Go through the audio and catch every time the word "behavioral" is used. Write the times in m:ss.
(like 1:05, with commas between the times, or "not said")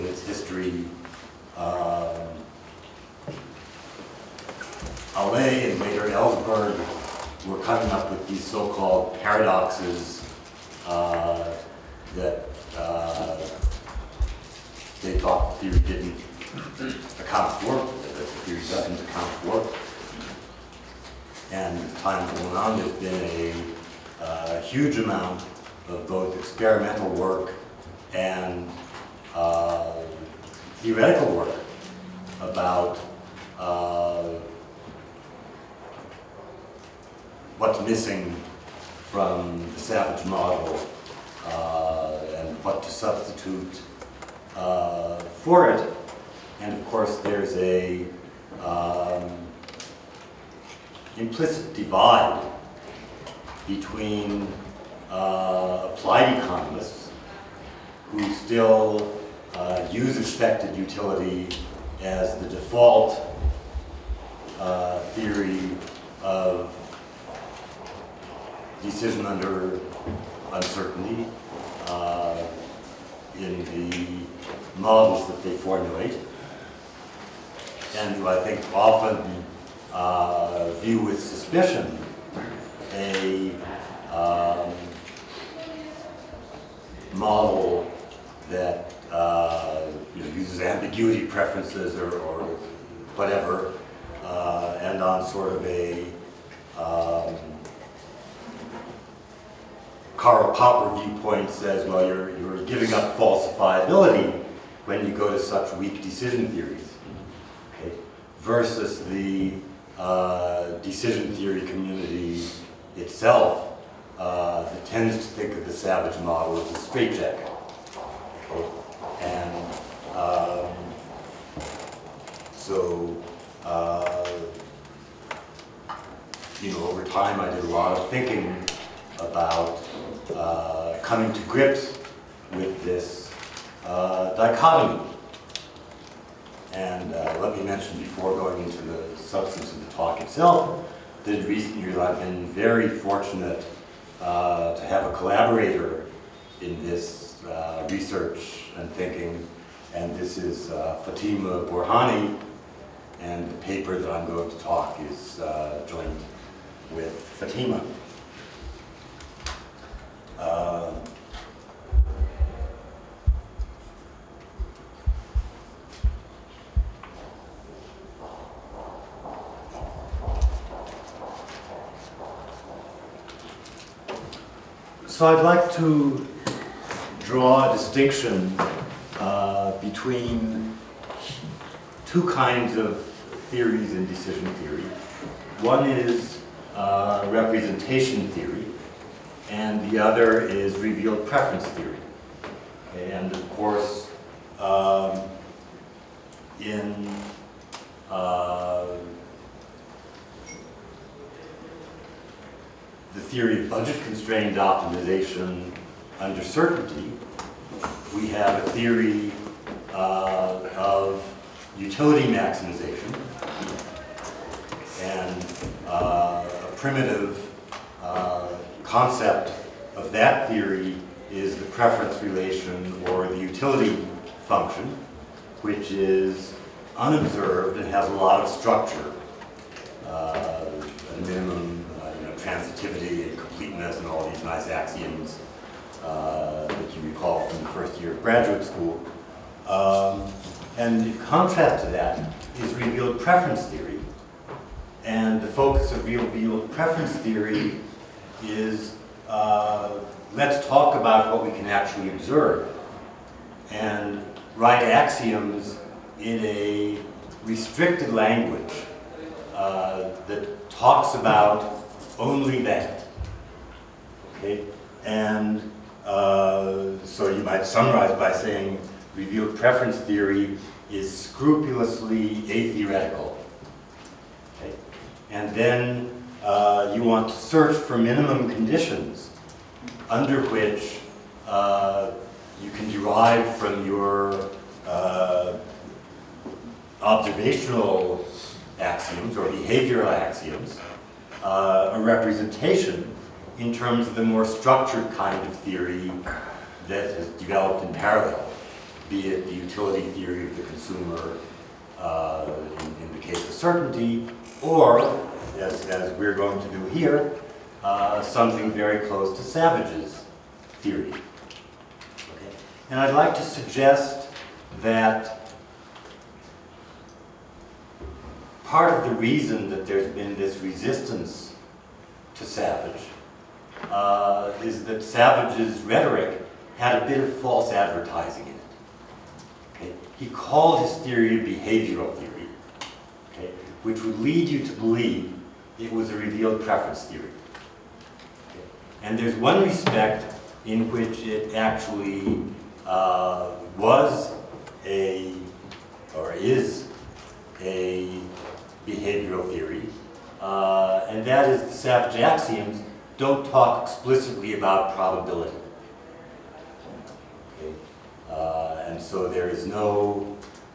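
4:49, 5:31, 5:48.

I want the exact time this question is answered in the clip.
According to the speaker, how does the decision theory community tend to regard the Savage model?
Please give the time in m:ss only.
1:56.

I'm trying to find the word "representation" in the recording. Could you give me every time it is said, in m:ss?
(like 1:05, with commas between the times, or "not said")
3:07, 4:52.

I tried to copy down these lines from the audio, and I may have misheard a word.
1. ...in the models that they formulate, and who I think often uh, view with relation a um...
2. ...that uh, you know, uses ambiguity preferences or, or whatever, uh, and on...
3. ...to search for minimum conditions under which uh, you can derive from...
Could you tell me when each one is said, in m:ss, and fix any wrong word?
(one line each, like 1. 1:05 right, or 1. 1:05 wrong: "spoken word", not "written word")
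1. 1:13 wrong: "suspicion", not "relation"
2. 1:28 right
3. 4:37 right.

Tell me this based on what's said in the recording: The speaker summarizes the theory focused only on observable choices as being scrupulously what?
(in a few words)
atheoretical.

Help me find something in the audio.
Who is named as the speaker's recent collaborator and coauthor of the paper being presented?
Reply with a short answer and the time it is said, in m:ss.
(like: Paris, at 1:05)
Fatemeh Borhani, at 2:31.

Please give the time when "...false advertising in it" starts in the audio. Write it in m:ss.
5:27.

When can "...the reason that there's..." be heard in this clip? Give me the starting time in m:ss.
5:19.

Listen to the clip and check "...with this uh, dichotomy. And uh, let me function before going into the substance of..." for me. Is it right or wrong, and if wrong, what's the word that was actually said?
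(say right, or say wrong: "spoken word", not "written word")
wrong: "mention", not "function".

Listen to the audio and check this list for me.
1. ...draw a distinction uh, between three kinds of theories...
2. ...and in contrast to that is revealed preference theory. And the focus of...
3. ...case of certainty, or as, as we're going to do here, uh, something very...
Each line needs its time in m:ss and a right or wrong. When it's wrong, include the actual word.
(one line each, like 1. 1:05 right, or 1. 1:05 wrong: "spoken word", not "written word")
1. 2:57 wrong: "two", not "three"
2. 4:00 right
3. 5:03 right.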